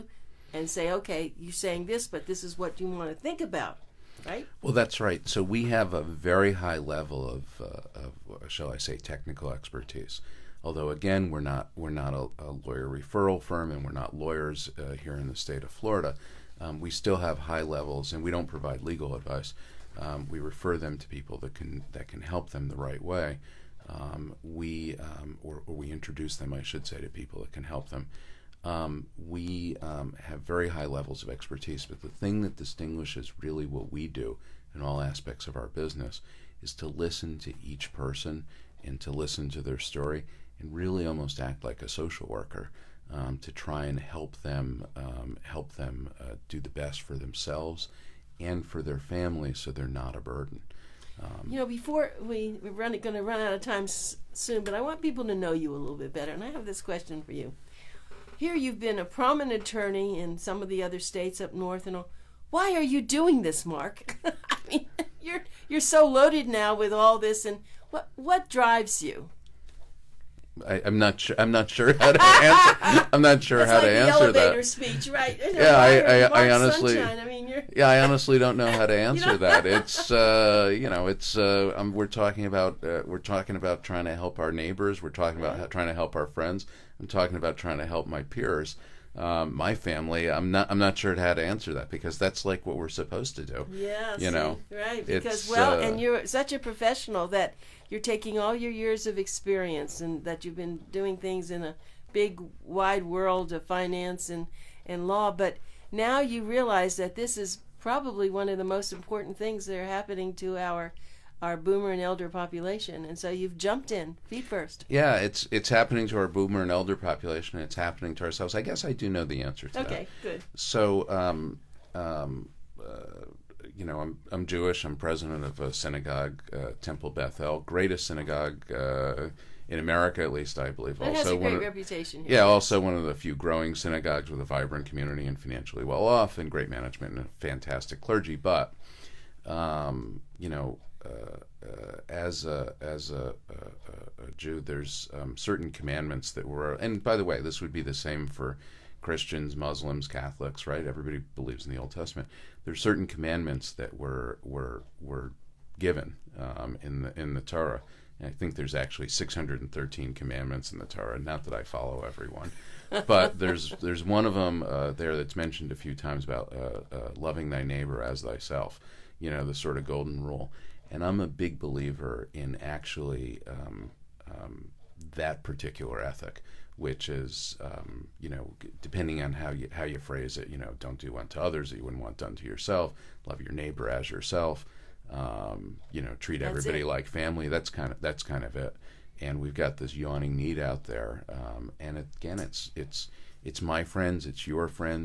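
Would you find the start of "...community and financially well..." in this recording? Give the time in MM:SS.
02:14.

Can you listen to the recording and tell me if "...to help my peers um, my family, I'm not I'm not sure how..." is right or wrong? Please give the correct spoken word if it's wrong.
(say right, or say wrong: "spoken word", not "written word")
right.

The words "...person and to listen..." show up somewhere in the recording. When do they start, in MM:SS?
00:37.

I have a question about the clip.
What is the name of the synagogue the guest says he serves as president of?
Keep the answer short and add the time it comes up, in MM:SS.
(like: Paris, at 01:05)
Temple Beth El, at 02:06.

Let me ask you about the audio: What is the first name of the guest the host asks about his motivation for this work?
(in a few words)
Mark.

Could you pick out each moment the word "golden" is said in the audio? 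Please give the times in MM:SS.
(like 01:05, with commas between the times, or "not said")
02:49.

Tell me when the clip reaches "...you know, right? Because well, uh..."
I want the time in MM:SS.
01:34.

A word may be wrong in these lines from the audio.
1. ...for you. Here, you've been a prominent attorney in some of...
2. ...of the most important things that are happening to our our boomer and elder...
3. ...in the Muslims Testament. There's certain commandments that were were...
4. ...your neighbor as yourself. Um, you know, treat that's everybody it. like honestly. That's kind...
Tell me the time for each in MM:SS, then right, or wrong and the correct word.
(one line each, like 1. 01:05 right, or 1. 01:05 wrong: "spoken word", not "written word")
1. 00:57 right
2. 01:48 right
3. 02:31 wrong: "Old", not "Muslims"
4. 03:03 wrong: "family", not "honestly".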